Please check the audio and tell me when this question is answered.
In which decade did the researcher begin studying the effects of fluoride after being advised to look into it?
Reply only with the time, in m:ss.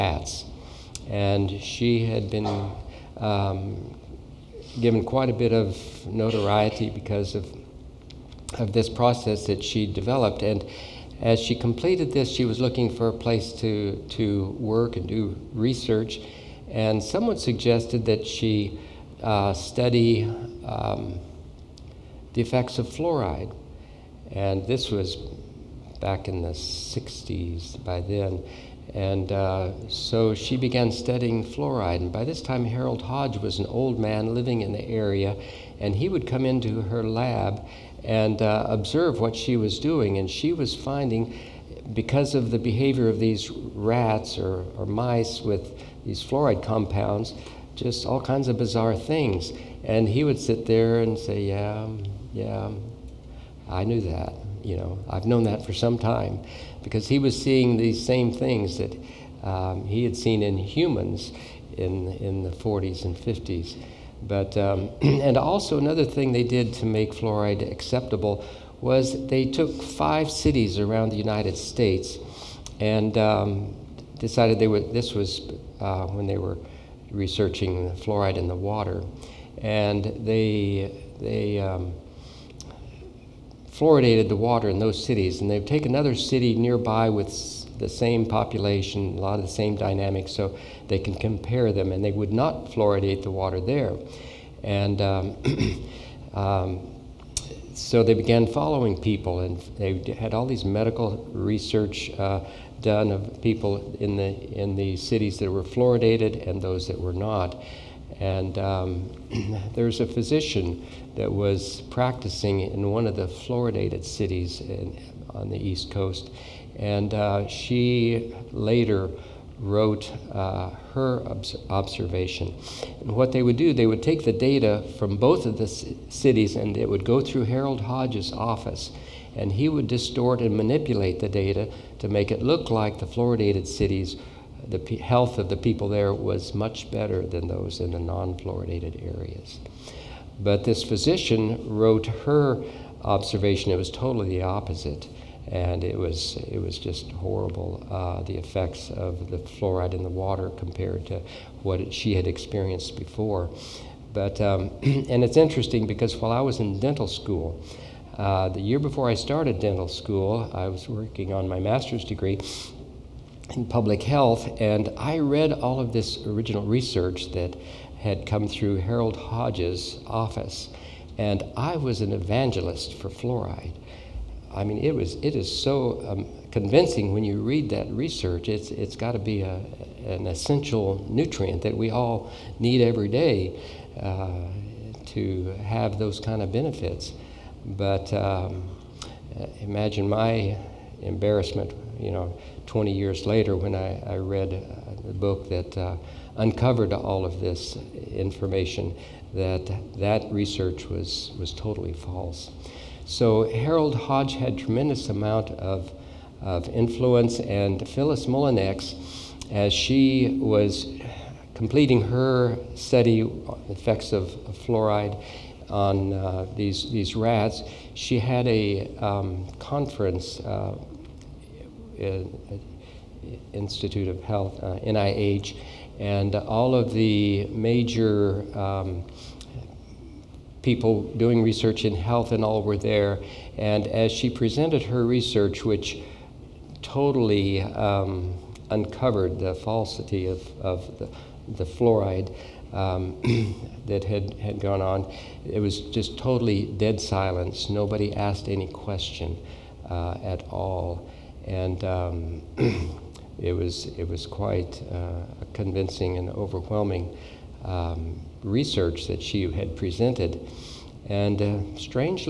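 0:26.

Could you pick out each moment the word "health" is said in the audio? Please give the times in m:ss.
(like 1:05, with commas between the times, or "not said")
2:14, 2:44, 3:44, 3:51.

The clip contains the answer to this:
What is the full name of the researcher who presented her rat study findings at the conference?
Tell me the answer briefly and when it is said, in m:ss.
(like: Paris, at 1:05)
Phyllis Mullenix, at 3:27.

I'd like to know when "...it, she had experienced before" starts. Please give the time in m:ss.
2:31.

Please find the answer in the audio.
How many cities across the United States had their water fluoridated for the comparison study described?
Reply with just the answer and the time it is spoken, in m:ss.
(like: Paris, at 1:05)
5, at 1:09.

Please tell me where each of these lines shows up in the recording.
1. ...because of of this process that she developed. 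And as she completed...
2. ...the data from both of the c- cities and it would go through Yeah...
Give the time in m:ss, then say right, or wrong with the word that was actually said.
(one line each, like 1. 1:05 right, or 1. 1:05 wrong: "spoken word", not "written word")
1. 0:06 right
2. 2:04 wrong: "Harold", not "Yeah".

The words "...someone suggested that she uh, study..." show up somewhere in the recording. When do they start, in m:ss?
0:17.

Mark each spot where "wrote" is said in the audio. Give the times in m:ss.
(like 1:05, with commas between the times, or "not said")
1:59, 2:21.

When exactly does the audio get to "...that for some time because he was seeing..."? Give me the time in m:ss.
0:55.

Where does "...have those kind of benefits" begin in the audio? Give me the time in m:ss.
3:05.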